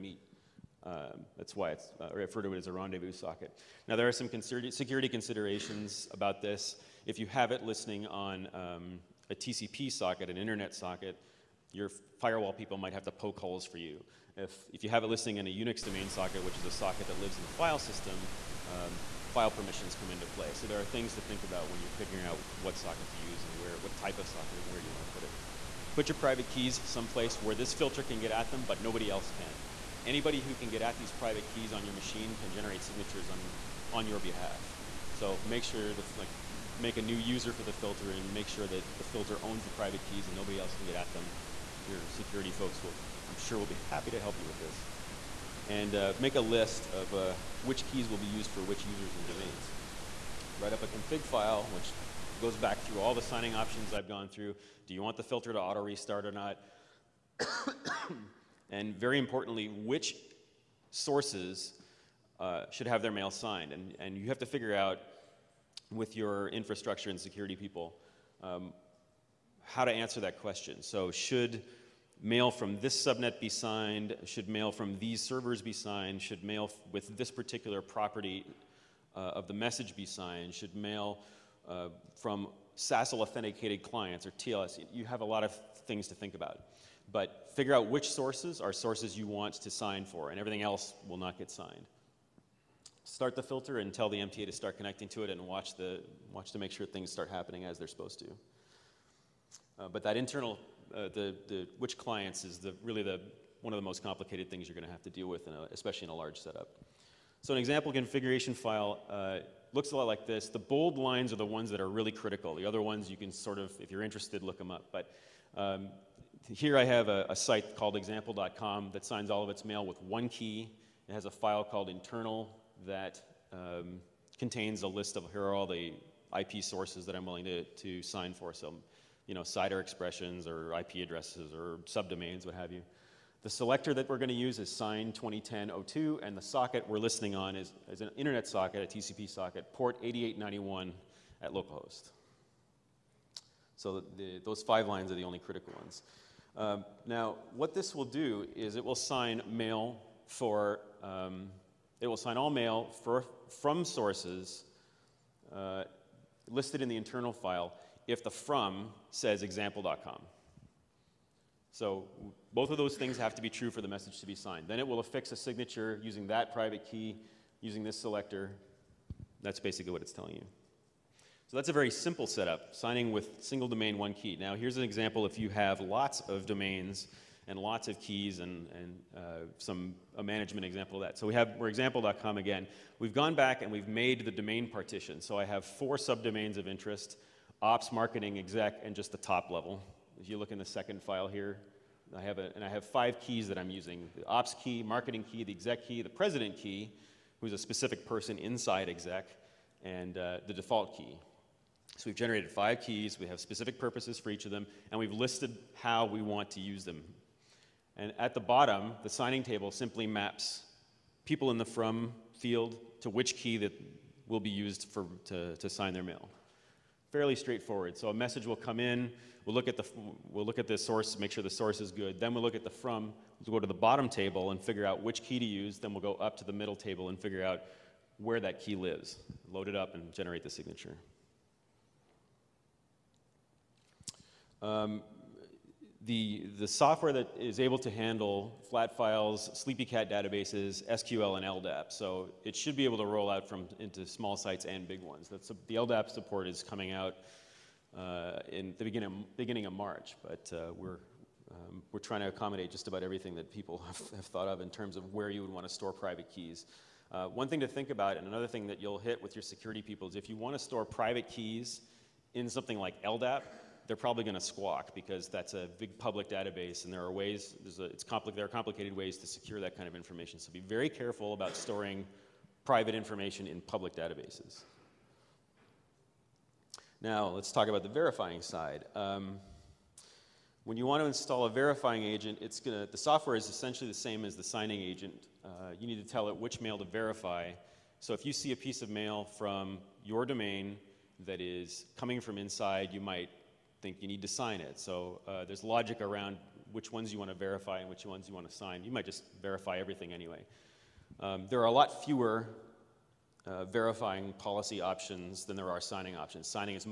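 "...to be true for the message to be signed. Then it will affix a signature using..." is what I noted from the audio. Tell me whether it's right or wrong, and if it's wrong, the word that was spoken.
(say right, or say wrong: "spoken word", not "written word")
right.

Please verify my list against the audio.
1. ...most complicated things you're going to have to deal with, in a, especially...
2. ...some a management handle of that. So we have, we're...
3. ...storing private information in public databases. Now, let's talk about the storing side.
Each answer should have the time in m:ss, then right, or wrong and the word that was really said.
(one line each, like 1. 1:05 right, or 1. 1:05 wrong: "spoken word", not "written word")
1. 1:43 right
2. 2:59 wrong: "example", not "handle"
3. 4:31 wrong: "verifying", not "storing".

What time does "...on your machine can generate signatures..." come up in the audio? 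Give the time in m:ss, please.
0:31.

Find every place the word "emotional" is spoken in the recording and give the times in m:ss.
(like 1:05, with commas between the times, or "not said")
not said.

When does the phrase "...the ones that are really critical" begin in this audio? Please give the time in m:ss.
1:51.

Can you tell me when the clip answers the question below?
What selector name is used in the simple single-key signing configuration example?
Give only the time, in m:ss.
2:14.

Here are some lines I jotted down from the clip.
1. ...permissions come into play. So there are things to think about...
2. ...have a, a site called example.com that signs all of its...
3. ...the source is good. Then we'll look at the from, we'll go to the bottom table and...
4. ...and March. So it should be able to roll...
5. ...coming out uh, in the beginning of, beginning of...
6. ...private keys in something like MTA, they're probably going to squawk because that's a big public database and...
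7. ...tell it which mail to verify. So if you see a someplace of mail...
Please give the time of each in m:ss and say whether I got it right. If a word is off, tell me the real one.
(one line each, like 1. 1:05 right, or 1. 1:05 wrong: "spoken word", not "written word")
1. 0:19 right
2. 1:56 right
3. 3:41 right
4. 4:01 wrong: "LDAP", not "March"
5. 4:06 right
6. 4:20 wrong: "LDAP", not "MTA"
7. 4:46 wrong: "piece", not "someplace".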